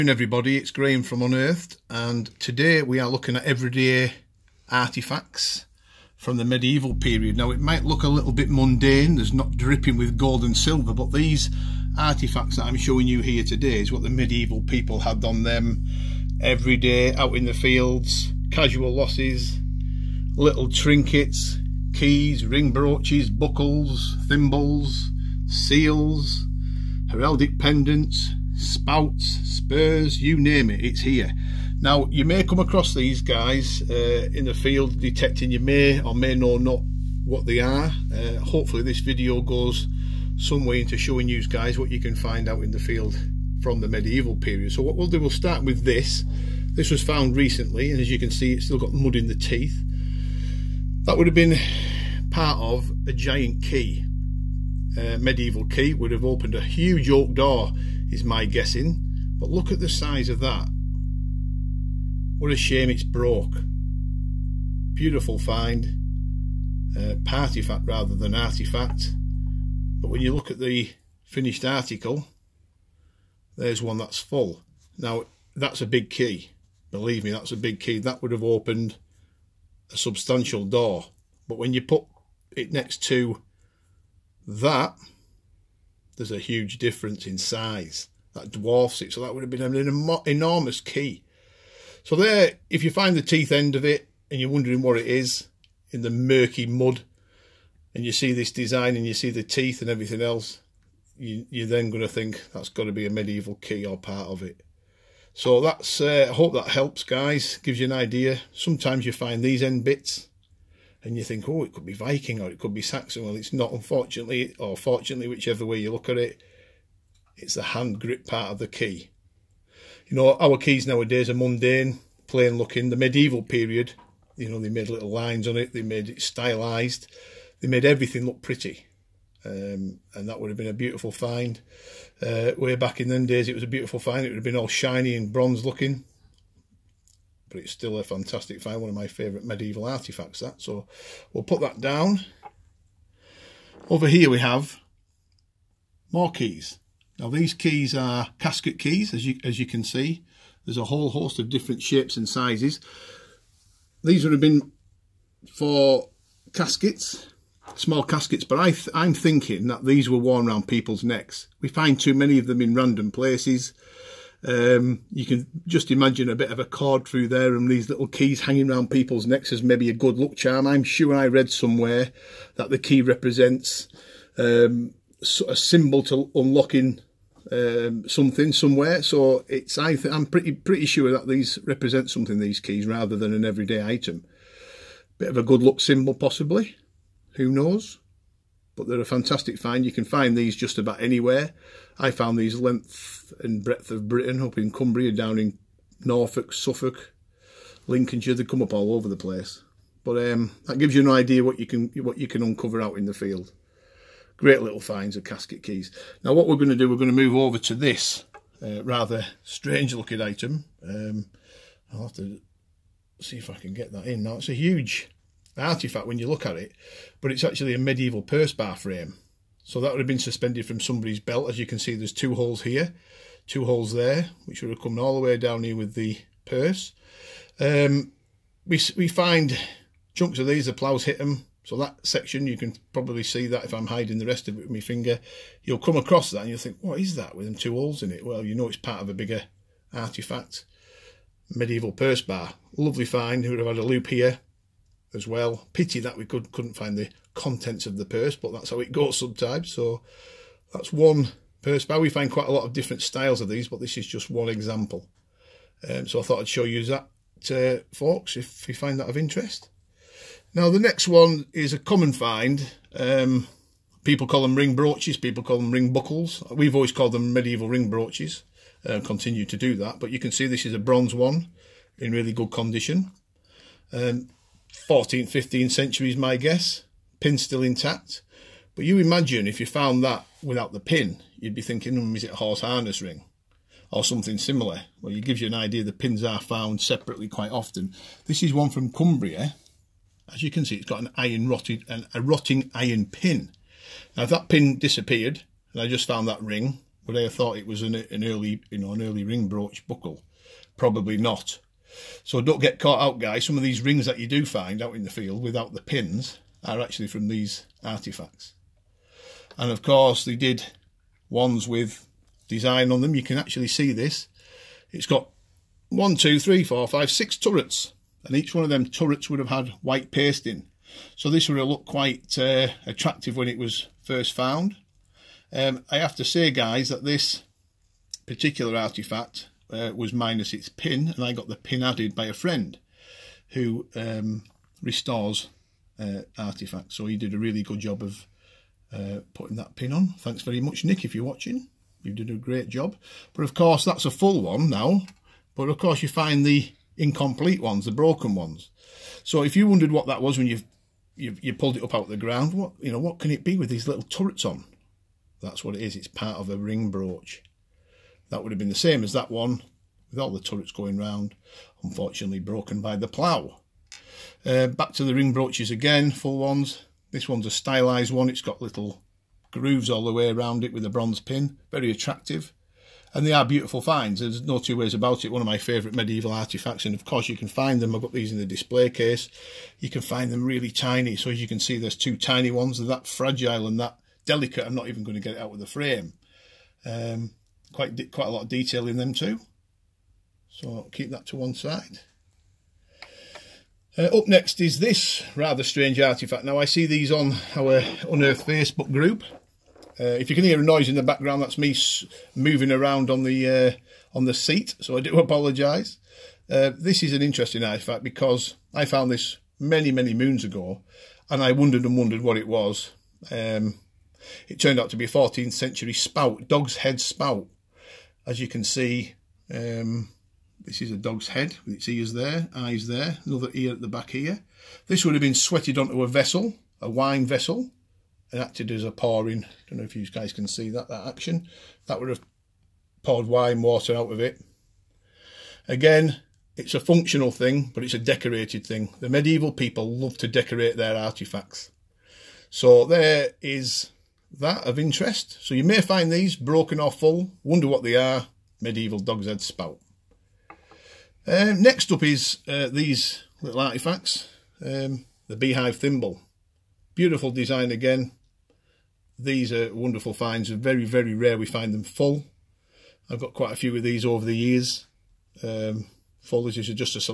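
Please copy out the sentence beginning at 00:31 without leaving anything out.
Now, you may come across these guys uh, in the field detecting you may or may know not what they are.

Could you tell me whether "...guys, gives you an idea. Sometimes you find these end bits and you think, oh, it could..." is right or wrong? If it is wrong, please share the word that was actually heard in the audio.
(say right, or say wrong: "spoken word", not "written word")
right.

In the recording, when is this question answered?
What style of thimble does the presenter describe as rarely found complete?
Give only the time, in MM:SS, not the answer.
07:35.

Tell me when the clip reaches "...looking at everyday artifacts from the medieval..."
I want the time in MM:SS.
00:03.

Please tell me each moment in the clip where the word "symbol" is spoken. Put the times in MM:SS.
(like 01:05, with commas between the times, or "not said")
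02:55, 03:05.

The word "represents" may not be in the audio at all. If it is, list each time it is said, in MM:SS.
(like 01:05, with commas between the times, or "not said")
02:53, 03:01.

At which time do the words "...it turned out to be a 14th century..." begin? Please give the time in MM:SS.
06:54.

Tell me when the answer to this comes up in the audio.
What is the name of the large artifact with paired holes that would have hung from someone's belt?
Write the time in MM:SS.
03:38.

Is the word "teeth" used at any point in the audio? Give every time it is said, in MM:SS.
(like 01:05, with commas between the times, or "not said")
00:49, 01:33, 01:39.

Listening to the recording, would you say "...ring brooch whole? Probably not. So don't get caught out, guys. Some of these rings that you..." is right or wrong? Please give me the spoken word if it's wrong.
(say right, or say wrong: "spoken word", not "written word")
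wrong: "buckle", not "whole".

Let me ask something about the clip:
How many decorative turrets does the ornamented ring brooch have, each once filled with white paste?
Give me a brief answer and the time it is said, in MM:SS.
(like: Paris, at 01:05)
6, at 05:17.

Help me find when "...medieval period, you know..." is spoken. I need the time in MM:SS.
02:02.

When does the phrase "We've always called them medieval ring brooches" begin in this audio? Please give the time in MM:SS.
04:26.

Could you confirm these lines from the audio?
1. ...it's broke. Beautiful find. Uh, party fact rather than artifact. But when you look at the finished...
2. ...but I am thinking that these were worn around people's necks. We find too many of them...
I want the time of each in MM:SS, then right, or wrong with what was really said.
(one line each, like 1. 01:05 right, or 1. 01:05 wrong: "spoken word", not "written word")
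1. 01:02 right
2. 02:38 right.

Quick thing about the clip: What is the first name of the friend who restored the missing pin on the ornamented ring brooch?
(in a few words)
Nick.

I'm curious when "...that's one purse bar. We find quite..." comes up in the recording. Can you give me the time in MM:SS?
04:10.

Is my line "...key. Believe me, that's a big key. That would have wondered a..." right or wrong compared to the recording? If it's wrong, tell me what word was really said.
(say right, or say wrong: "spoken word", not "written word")
wrong: "opened", not "wondered".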